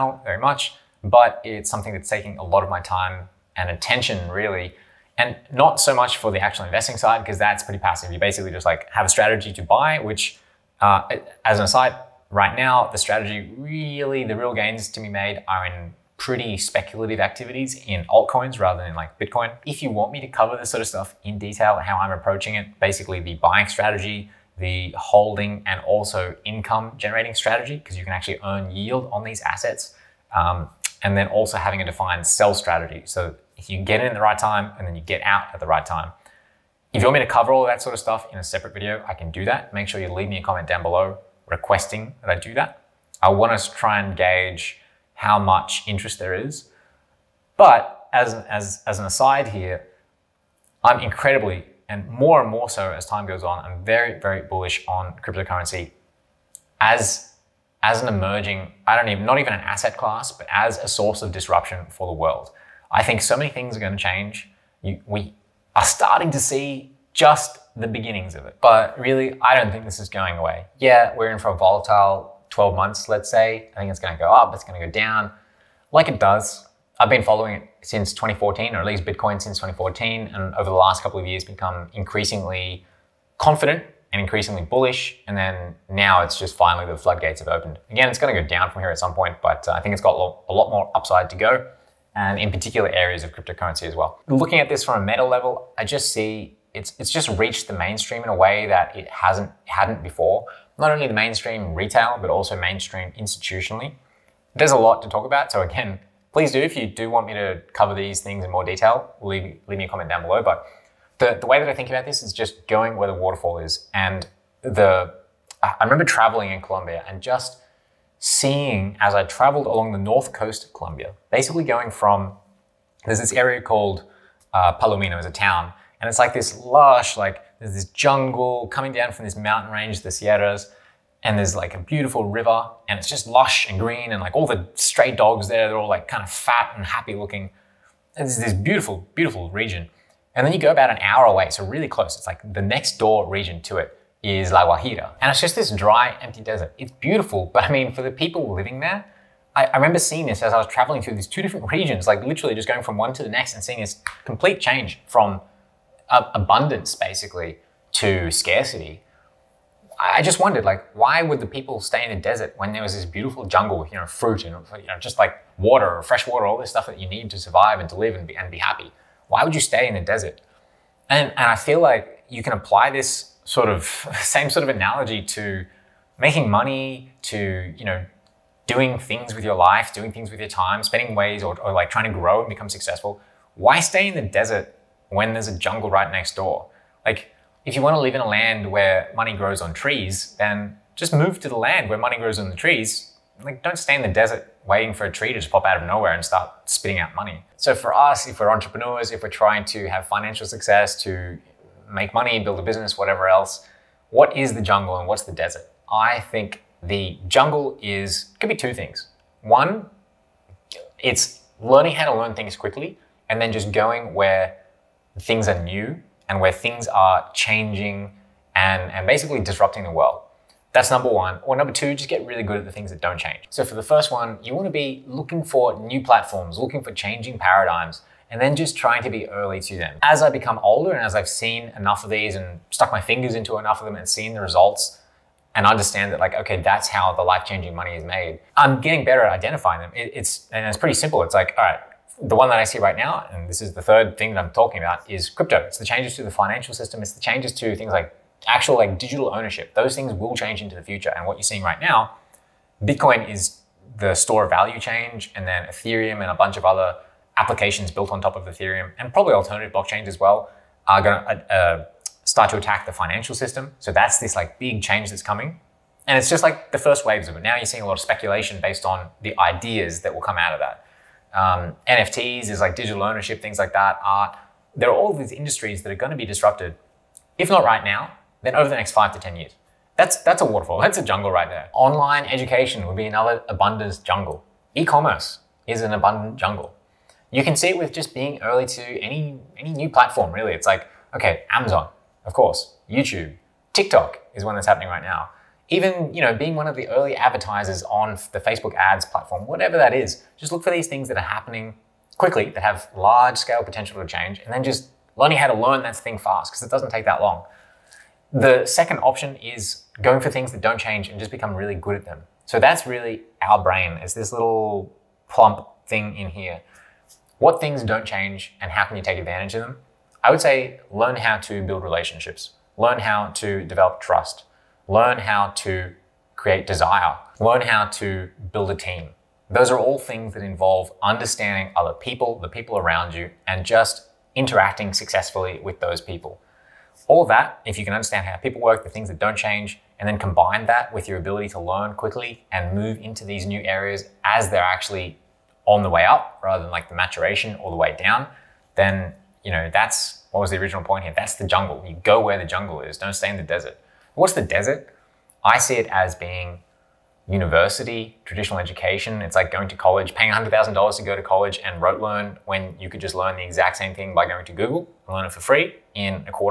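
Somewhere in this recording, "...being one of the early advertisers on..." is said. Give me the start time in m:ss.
4:56.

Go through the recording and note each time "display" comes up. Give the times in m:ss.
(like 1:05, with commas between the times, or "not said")
not said.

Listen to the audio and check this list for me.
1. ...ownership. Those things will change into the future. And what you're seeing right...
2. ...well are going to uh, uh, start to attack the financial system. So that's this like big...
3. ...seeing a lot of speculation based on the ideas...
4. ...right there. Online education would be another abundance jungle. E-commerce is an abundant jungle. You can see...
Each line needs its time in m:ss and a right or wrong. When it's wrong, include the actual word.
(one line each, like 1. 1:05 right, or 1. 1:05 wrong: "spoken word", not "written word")
1. 4:09 right
2. 4:20 right
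3. 4:27 right
4. 4:41 right.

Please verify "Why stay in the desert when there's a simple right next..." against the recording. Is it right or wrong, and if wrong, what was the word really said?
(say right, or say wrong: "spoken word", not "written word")
wrong: "jungle", not "simple".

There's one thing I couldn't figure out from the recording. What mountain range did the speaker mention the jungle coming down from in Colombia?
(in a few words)
The Sierras.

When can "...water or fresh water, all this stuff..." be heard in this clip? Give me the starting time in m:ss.
2:45.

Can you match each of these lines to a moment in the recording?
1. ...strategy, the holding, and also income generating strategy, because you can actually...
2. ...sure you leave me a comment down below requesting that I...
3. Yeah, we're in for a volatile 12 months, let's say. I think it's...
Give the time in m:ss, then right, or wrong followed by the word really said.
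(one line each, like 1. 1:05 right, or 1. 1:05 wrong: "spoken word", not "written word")
1. 0:23 right
2. 0:39 right
3. 1:10 right.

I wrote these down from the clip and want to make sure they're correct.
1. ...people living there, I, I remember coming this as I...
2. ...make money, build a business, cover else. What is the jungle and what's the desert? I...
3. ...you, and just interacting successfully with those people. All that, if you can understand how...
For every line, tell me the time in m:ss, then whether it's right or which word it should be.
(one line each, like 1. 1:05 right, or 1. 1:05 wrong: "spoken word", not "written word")
1. 2:28 wrong: "seeing", not "coming"
2. 3:21 wrong: "whatever", not "cover"
3. 5:33 right.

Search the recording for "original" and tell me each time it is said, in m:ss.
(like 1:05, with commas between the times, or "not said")
5:50.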